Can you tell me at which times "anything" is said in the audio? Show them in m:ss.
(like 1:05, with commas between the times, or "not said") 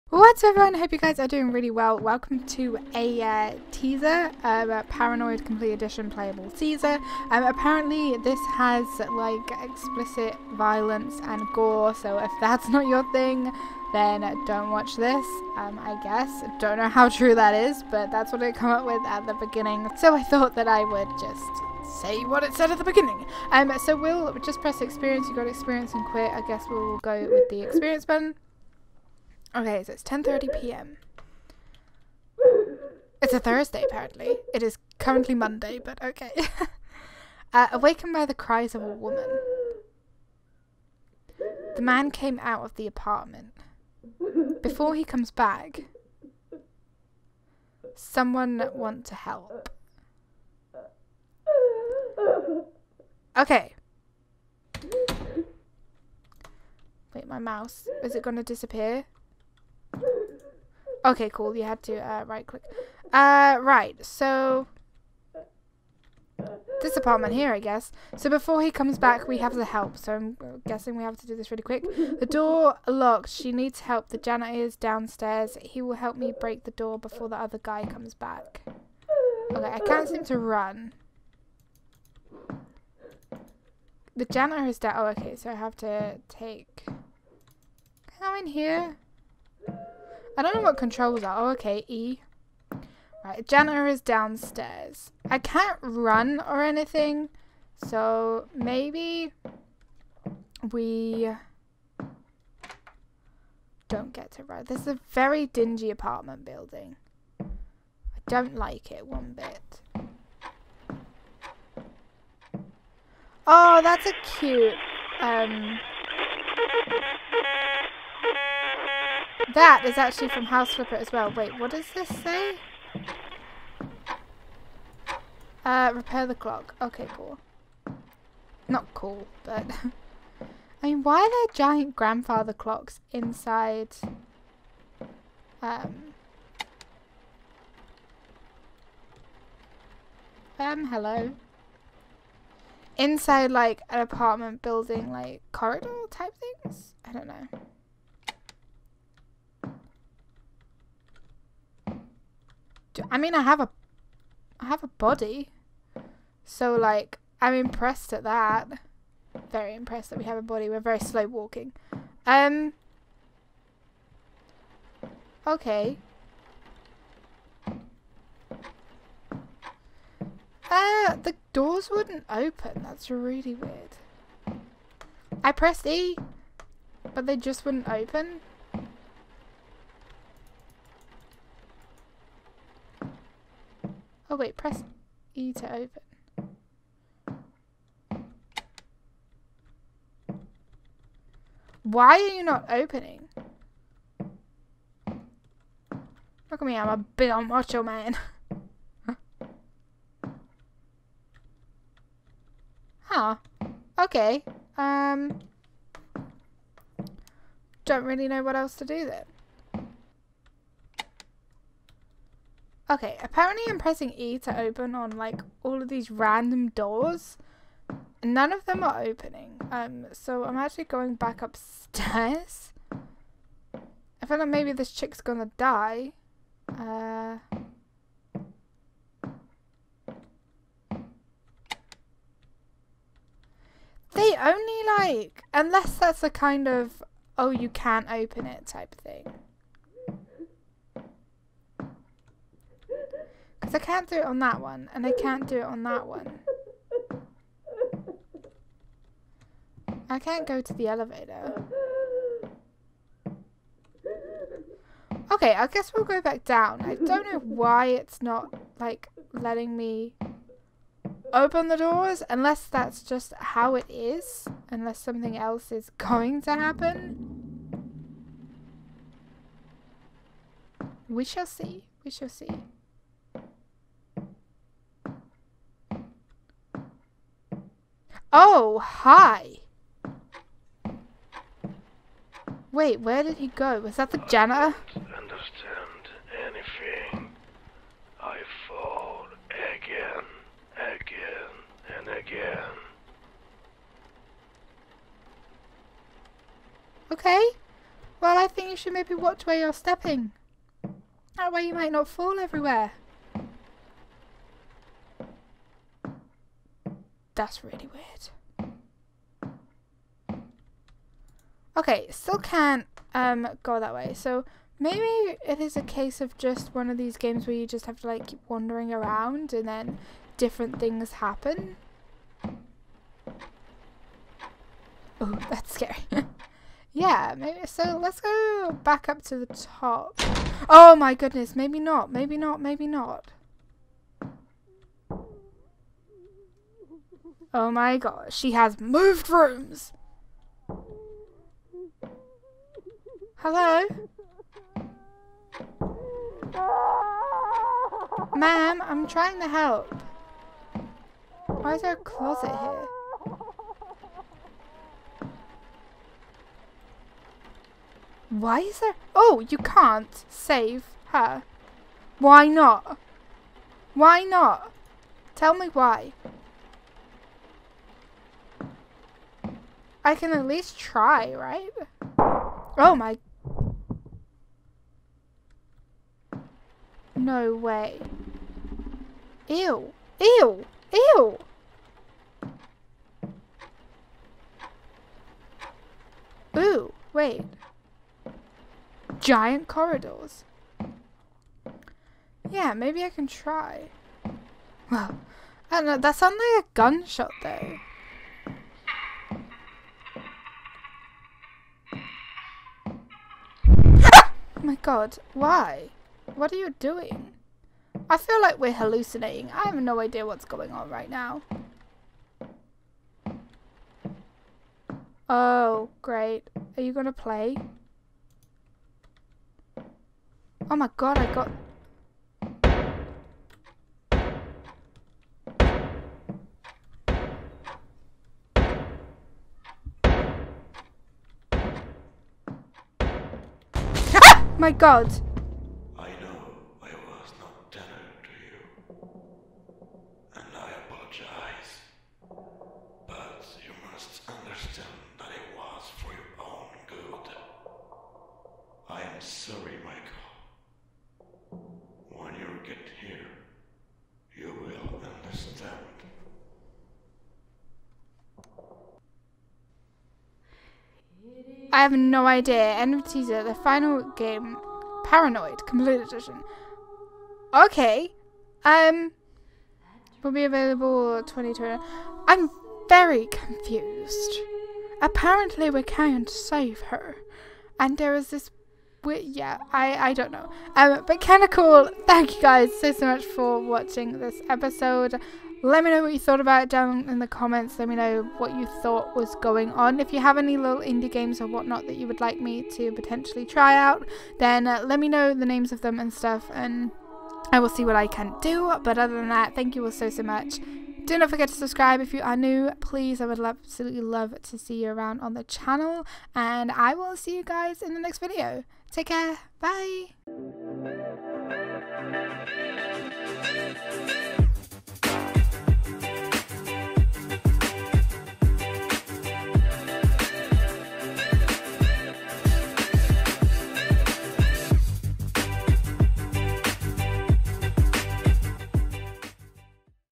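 1:36, 4:46.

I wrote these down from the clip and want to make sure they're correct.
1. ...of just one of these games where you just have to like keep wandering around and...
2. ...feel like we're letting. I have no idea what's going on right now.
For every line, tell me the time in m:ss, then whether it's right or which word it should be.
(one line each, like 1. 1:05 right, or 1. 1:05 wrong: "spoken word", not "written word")
1. 5:16 right
2. 6:48 wrong: "hallucinating", not "letting".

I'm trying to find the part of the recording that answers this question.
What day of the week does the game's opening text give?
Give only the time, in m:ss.
0:33.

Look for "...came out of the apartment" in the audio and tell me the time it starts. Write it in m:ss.
0:42.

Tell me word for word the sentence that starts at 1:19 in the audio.
Okay, I can't seem to run.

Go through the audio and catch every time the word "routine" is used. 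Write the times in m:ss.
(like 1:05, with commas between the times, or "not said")
not said.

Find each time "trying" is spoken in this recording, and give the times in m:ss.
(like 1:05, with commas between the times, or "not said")
5:49, 7:55.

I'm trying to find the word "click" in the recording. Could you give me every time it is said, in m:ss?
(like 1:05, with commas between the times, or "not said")
1:02.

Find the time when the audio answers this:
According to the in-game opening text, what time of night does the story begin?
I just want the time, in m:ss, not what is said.
0:30.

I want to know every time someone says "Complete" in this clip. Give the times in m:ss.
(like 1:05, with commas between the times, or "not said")
0:05, 7:45.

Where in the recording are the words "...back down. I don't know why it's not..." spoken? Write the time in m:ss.
4:16.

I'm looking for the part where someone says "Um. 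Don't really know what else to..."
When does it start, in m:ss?
3:24.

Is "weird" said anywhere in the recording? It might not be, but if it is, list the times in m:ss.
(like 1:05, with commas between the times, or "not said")
2:53, 5:07.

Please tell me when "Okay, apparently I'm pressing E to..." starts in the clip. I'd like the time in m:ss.
3:32.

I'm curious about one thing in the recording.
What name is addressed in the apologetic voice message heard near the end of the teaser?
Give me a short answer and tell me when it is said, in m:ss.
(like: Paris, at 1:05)
Michael, at 7:29.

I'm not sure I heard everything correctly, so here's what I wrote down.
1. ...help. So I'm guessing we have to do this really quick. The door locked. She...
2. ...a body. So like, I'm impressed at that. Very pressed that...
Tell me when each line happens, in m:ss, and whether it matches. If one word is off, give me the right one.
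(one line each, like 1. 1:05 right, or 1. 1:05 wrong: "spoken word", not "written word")
1. 1:09 right
2. 2:34 wrong: "impressed", not "pressed".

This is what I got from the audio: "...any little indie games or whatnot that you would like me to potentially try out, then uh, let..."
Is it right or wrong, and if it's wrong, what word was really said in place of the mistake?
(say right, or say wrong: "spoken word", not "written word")
right.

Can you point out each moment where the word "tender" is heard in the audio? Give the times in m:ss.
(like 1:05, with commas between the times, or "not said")
7:17.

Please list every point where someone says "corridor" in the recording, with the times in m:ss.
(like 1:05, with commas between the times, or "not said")
2:25, 6:29.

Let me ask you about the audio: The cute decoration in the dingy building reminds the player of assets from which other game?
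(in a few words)
House Flipper.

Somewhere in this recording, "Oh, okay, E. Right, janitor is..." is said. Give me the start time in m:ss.
1:31.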